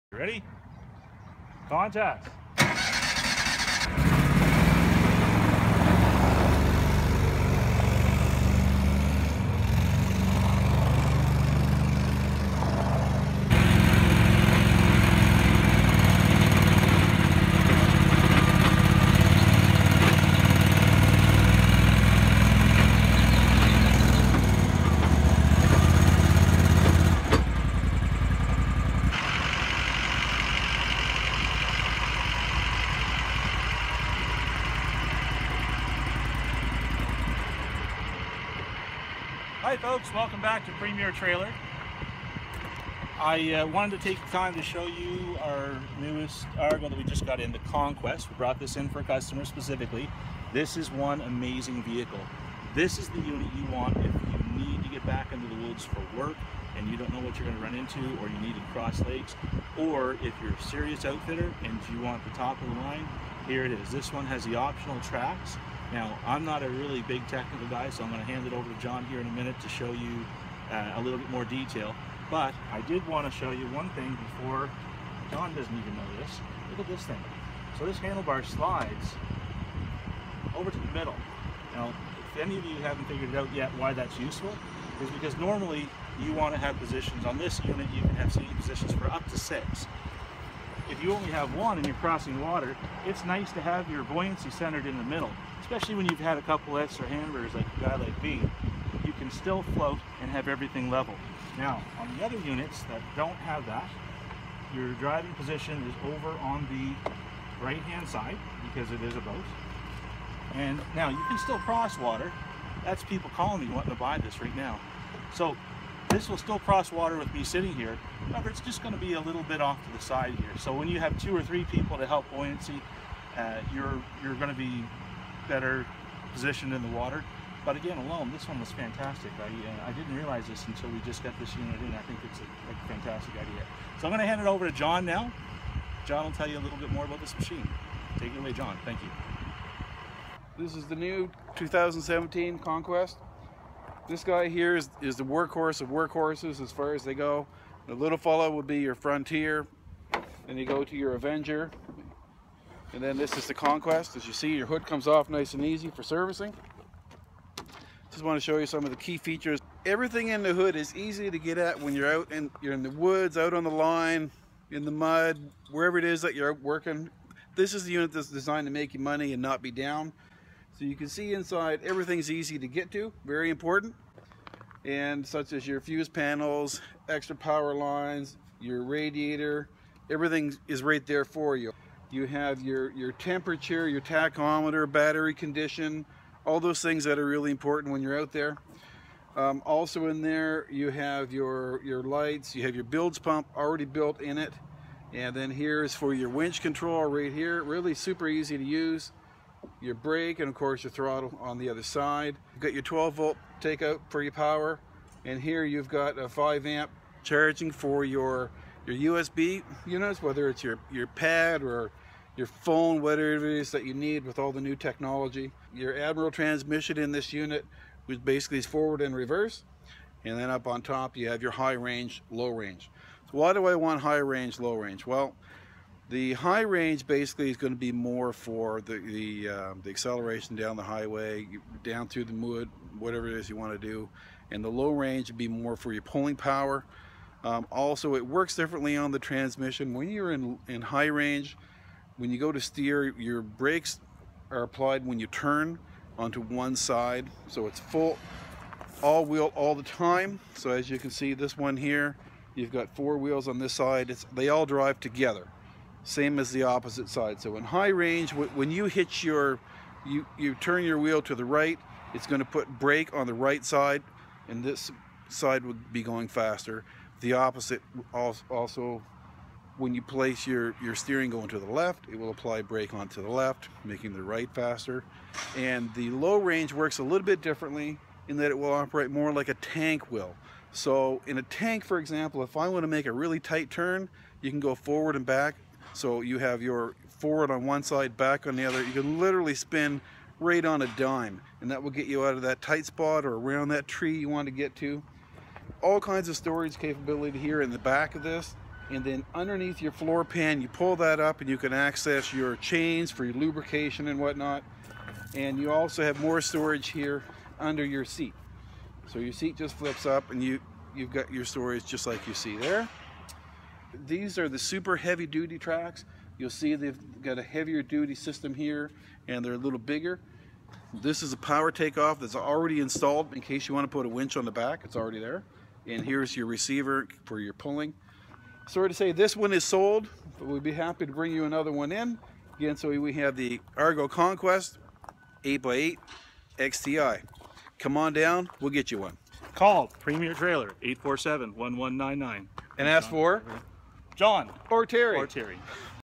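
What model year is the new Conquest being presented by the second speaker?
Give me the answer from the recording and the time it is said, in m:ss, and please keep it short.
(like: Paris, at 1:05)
2017, at 2:21.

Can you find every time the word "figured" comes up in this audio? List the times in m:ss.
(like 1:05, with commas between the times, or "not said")
1:23.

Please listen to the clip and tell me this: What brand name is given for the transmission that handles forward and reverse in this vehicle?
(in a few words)
Admiral.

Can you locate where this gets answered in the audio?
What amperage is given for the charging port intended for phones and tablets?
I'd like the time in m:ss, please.
3:26.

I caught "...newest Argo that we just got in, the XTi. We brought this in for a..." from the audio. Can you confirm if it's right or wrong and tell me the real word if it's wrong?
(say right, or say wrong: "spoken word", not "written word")
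wrong: "Conquest", not "XTi".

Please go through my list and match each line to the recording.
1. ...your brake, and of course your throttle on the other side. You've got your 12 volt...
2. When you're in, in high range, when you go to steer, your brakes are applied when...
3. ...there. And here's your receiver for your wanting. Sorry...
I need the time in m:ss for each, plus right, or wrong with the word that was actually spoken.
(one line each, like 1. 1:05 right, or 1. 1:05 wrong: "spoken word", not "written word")
1. 3:19 right
2. 3:59 right
3. 5:25 wrong: "pulling", not "wanting".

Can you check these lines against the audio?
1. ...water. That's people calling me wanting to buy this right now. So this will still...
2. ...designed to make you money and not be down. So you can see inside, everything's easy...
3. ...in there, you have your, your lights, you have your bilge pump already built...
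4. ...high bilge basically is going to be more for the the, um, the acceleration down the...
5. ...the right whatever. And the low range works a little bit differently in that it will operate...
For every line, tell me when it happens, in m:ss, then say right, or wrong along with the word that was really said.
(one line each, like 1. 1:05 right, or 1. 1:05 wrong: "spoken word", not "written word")
1. 1:51 right
2. 2:48 right
3. 3:10 right
4. 3:46 wrong: "range", not "bilge"
5. 4:34 wrong: "faster", not "whatever".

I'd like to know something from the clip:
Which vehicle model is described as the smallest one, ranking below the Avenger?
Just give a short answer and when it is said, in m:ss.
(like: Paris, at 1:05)
Frontier, at 2:28.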